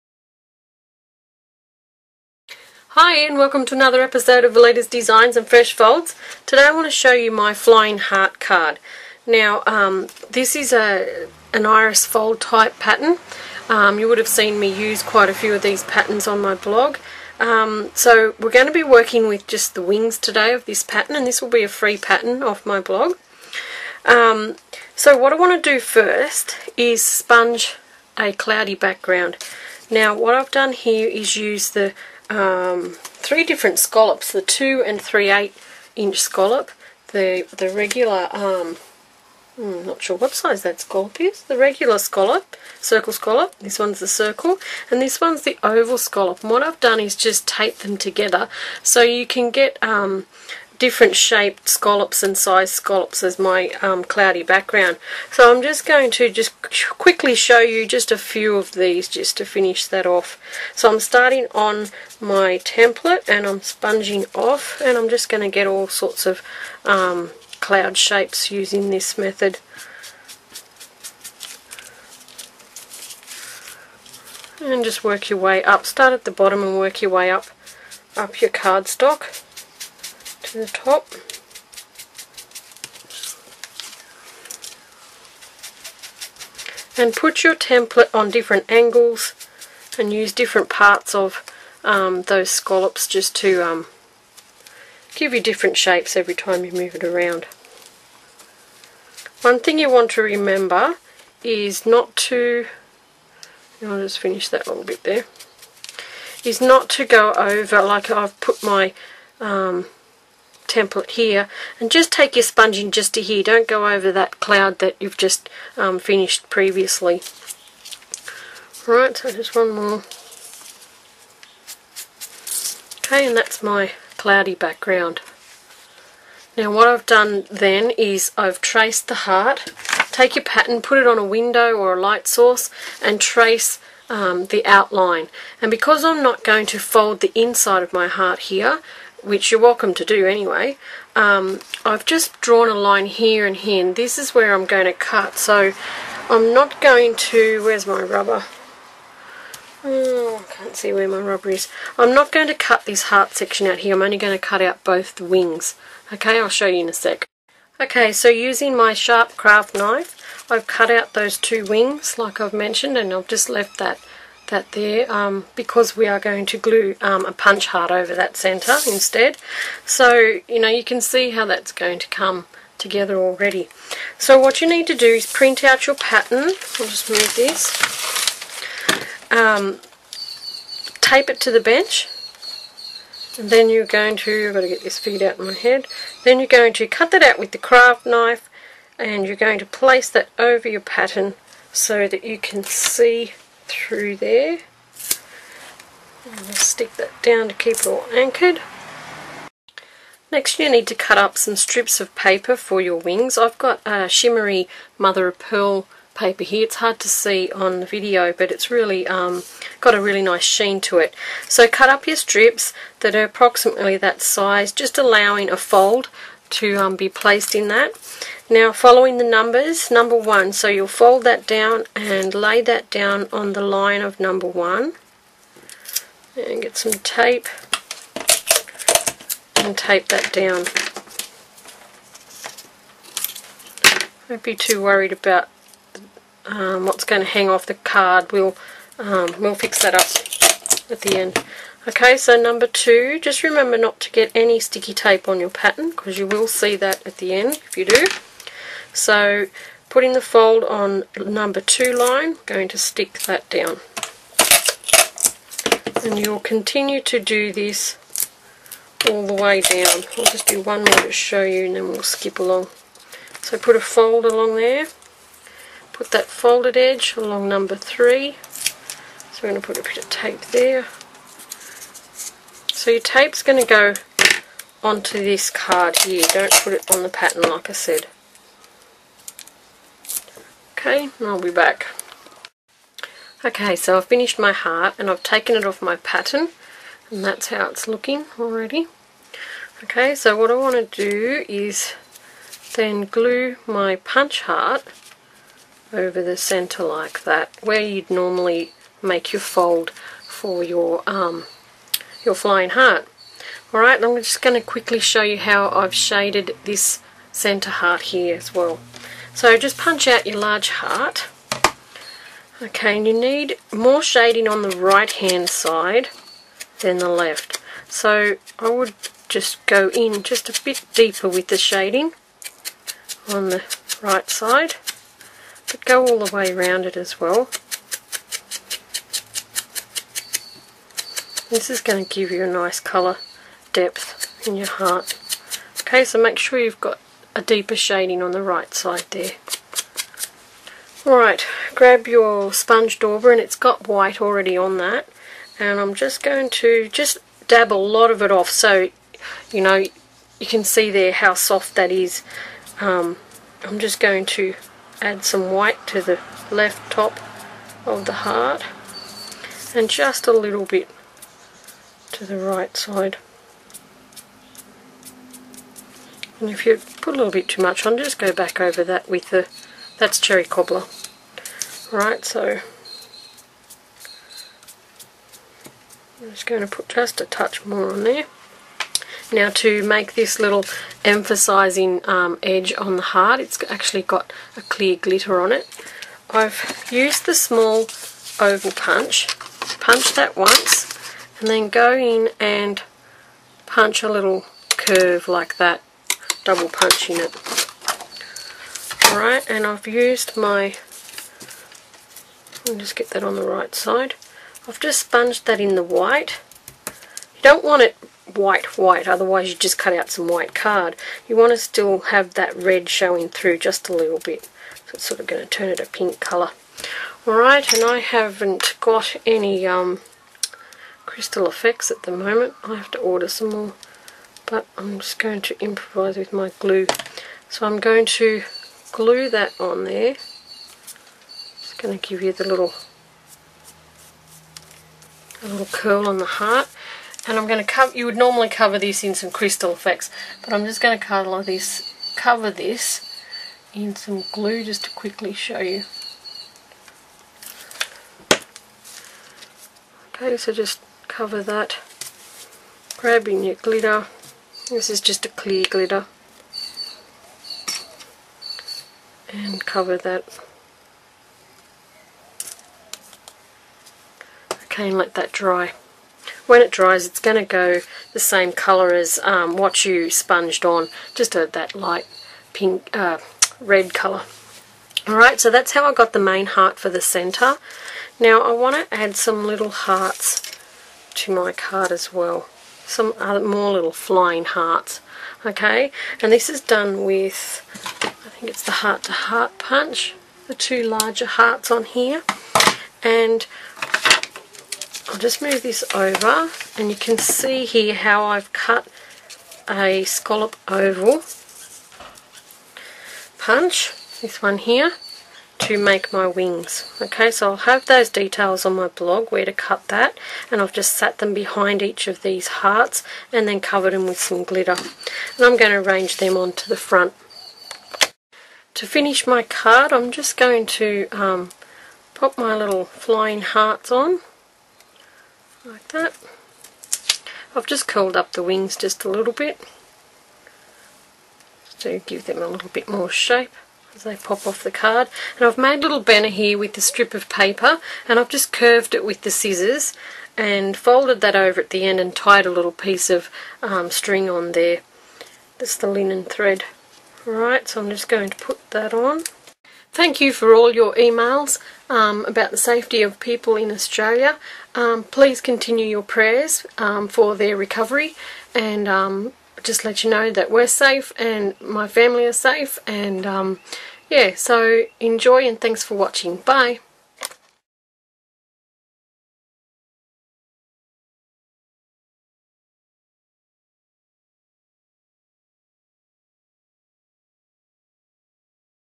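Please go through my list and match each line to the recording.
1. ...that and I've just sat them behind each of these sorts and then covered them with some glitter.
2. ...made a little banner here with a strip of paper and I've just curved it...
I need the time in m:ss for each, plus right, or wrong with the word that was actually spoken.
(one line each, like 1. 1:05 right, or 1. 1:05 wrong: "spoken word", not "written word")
1. 8:29 wrong: "hearts", not "sorts"
2. 8:55 right.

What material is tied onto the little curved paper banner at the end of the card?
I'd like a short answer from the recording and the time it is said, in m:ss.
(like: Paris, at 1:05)
linen thread, at 9:05.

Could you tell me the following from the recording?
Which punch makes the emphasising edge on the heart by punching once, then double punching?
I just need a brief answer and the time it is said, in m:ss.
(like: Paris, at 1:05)
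small oval punch, at 6:27.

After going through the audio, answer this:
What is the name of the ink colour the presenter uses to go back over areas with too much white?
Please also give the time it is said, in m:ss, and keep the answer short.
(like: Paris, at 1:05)
cherry cobbler, at 6:10.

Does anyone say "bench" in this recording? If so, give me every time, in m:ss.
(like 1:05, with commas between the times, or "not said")
3:01.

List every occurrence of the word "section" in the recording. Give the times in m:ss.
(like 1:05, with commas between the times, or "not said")
2:33.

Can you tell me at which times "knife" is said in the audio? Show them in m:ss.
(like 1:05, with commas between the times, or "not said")
2:39, 3:08.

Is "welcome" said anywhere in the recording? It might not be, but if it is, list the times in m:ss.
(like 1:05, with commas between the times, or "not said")
0:03, 2:19.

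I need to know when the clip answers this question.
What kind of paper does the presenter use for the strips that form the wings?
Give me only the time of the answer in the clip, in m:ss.
3:24.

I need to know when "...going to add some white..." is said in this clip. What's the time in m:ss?
5:53.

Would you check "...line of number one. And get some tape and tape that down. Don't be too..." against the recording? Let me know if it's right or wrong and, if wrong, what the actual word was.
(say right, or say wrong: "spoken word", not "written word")
right.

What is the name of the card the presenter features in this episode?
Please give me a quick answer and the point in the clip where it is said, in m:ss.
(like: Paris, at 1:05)
Flying Heart card, at 0:07.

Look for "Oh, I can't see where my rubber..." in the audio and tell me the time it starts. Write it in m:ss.
2:29.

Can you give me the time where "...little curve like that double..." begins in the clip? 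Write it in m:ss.
6:34.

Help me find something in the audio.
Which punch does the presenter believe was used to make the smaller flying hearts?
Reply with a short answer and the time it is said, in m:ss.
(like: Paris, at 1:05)
heart to heart punch, at 8:08.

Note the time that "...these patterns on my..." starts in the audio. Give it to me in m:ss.
0:15.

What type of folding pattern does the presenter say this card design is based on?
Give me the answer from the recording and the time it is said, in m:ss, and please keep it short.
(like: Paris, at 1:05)
iris fold, at 0:11.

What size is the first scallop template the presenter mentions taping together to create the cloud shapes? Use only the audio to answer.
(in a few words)
2 and 3/8 inch.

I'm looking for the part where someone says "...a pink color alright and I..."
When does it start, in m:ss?
6:55.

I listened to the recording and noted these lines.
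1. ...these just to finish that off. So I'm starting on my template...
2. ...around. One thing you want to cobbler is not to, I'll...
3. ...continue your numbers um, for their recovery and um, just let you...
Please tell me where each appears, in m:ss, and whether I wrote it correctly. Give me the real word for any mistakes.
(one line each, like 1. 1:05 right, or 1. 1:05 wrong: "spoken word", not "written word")
1. 0:58 right
2. 1:37 wrong: "remember", not "cobbler"
3. 9:15 wrong: "prayers", not "numbers".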